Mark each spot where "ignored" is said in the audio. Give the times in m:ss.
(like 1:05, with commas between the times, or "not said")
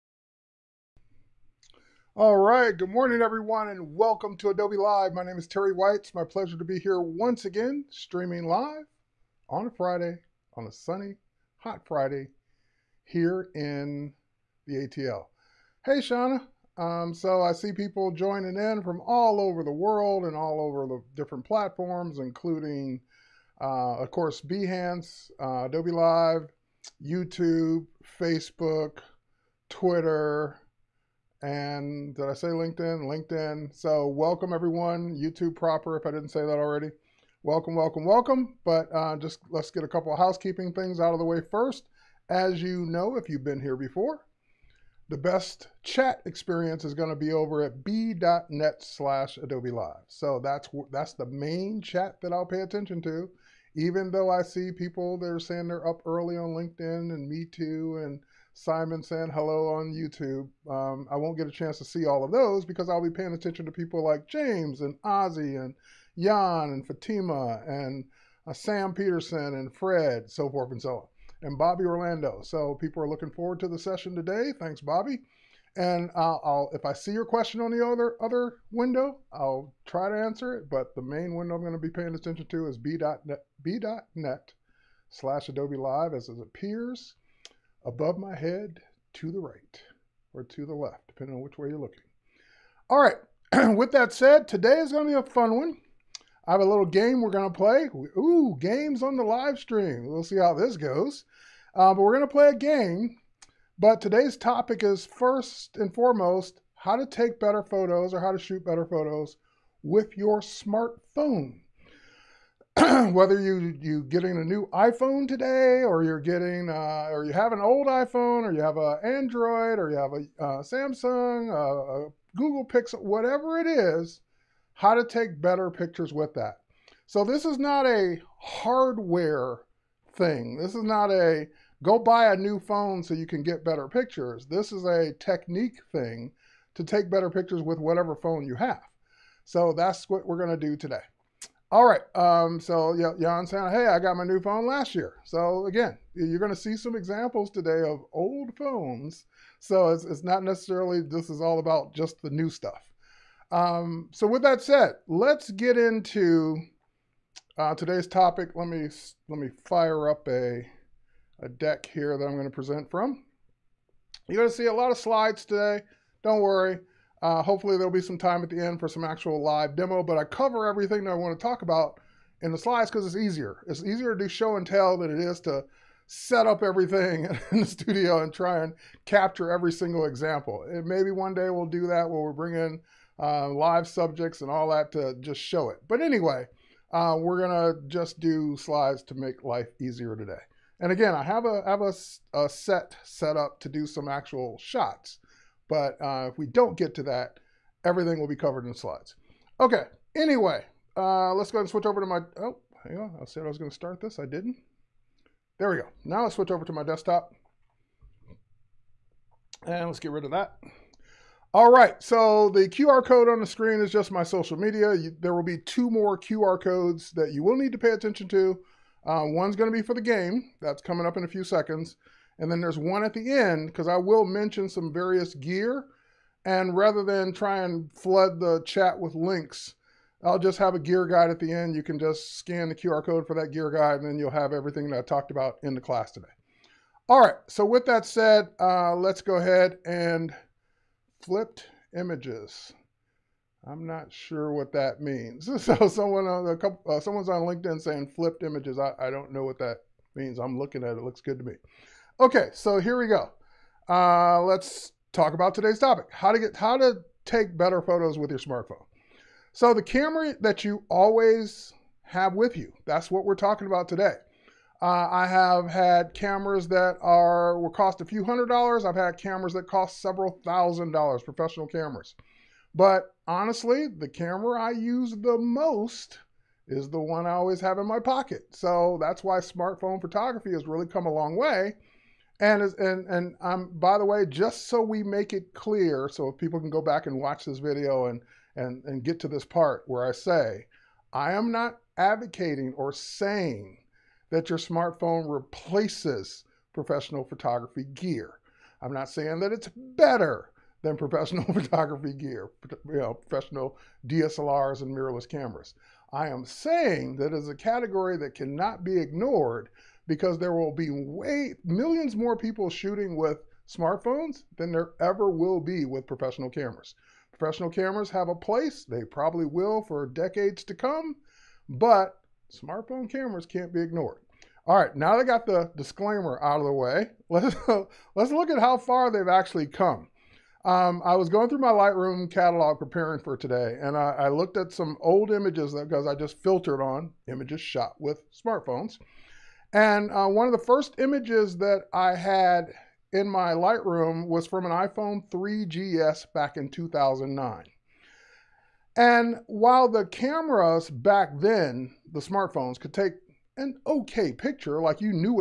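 5:08, 5:23.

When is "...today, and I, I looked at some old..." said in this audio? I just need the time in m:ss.
5:33.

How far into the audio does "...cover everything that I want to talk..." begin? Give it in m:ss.
2:50.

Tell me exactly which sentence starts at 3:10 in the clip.
And again, I have a have a, a set set up to do some actual shots.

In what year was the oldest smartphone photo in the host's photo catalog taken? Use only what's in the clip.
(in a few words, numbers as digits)
2009.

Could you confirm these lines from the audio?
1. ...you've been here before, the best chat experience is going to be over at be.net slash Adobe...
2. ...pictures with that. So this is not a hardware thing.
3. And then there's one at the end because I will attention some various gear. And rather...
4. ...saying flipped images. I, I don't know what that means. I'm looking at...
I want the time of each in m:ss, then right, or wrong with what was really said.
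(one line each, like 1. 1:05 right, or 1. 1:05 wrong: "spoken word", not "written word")
1. 0:43 right
2. 2:05 right
3. 3:42 wrong: "mention", not "attention"
4. 4:07 right.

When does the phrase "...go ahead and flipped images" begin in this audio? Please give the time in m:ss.
3:59.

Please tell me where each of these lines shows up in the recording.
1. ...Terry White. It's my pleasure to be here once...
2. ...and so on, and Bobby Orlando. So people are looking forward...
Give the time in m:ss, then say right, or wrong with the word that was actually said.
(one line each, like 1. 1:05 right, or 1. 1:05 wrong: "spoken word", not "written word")
1. 0:05 right
2. 1:10 right.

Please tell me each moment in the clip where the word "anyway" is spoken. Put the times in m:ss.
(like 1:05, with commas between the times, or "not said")
3:06, 3:20.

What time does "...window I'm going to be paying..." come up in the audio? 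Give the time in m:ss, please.
1:21.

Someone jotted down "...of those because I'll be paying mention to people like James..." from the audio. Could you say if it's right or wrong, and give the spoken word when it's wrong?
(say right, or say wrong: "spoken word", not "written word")
wrong: "attention", not "mention".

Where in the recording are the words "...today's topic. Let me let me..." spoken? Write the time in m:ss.
2:37.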